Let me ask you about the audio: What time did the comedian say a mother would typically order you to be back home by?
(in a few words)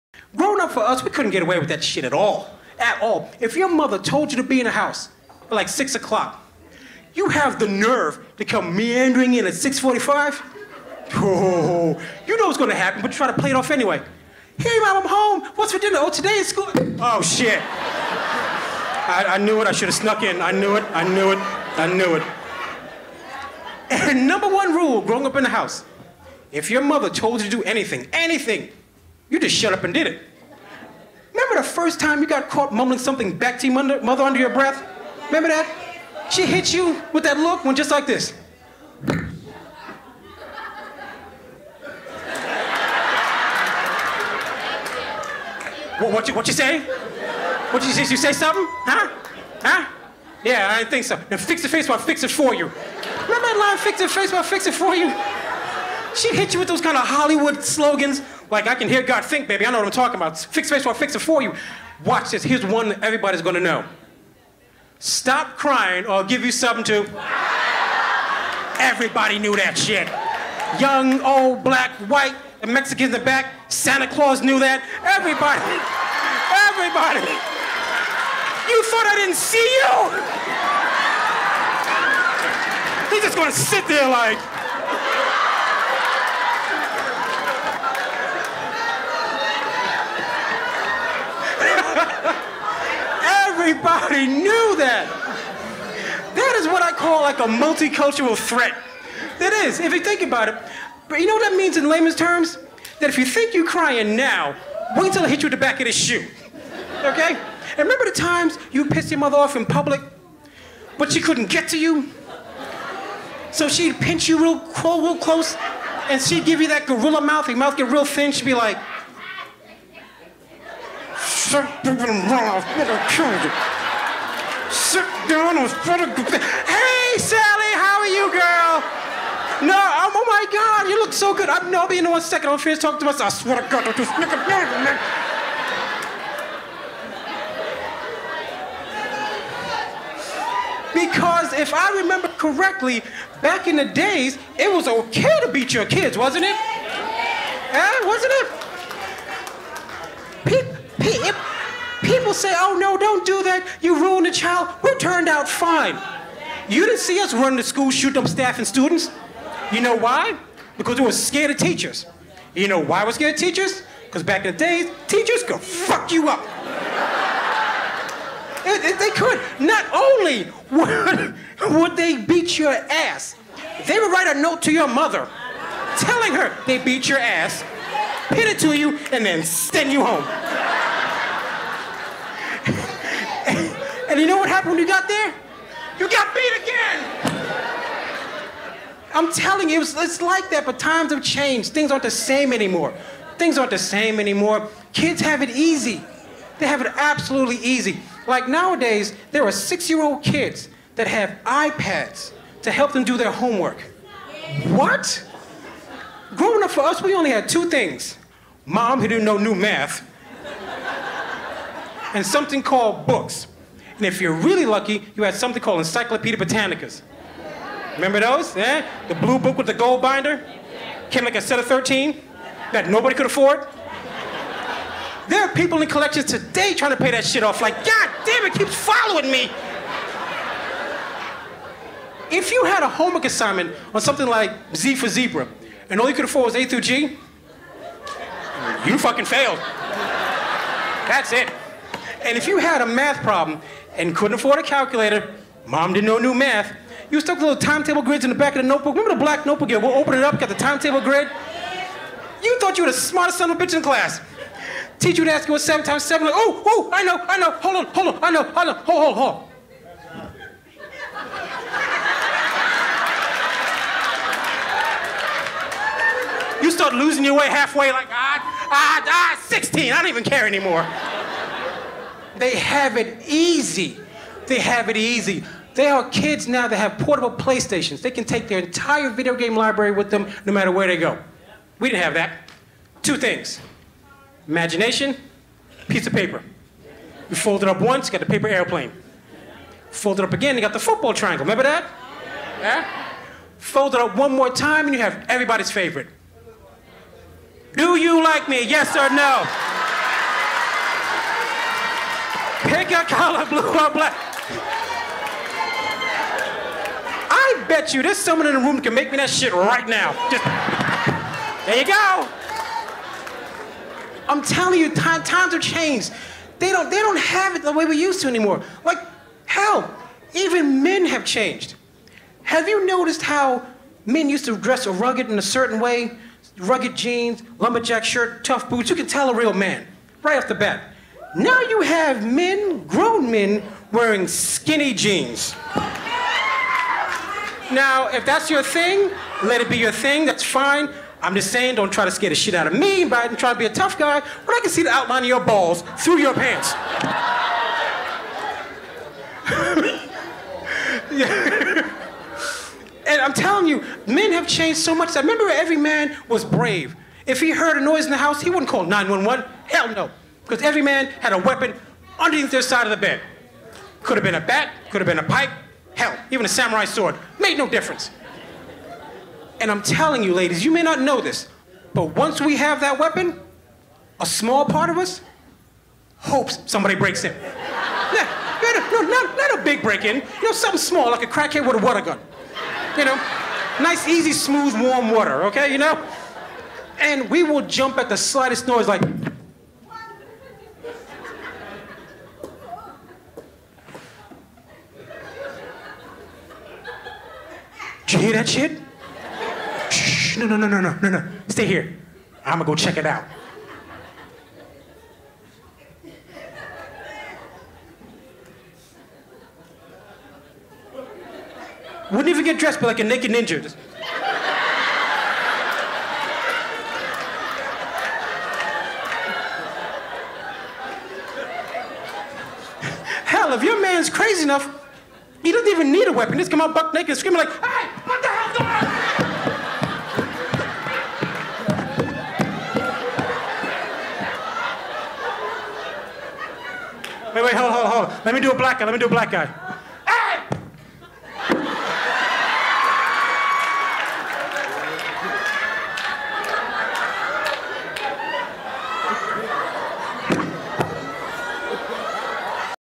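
6 o'clock.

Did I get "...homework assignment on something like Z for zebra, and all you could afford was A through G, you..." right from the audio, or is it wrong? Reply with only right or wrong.
right.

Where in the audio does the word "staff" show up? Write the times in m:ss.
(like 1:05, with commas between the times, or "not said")
2:38.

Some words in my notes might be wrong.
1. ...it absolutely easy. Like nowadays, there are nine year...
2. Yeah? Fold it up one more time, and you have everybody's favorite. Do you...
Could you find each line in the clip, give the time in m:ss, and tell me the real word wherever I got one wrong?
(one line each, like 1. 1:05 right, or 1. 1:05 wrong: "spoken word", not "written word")
1. 3:16 wrong: "six", not "nine"
2. 4:52 right.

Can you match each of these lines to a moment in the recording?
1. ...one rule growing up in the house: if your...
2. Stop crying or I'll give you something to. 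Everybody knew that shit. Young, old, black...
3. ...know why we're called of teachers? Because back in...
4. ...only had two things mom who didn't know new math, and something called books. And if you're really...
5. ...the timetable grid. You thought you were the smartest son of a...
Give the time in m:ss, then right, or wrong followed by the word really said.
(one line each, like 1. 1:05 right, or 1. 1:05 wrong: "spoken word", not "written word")
1. 0:24 right
2. 1:04 right
3. 2:42 wrong: "scared", not "called"
4. 3:27 right
5. 4:10 right.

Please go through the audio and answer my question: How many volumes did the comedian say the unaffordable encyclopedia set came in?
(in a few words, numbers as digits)
13.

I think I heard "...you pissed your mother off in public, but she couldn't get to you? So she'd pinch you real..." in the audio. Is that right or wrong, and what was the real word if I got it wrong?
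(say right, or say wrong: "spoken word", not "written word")
right.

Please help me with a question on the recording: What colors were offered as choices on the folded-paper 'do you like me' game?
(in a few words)
Blue or black.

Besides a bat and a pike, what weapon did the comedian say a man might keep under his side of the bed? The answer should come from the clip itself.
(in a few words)
Samurai sword.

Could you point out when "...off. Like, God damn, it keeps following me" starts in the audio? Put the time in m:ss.
3:47.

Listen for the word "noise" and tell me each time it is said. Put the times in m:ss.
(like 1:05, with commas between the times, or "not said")
5:57, 6:28.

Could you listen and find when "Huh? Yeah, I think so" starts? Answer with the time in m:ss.
0:49.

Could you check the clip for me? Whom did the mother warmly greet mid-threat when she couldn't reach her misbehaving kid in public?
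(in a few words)
Sally.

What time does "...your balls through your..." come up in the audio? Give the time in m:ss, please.
5:45.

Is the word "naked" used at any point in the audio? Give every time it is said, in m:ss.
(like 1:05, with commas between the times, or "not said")
6:53, 7:06.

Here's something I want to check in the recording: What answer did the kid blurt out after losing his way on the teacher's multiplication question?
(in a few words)
16.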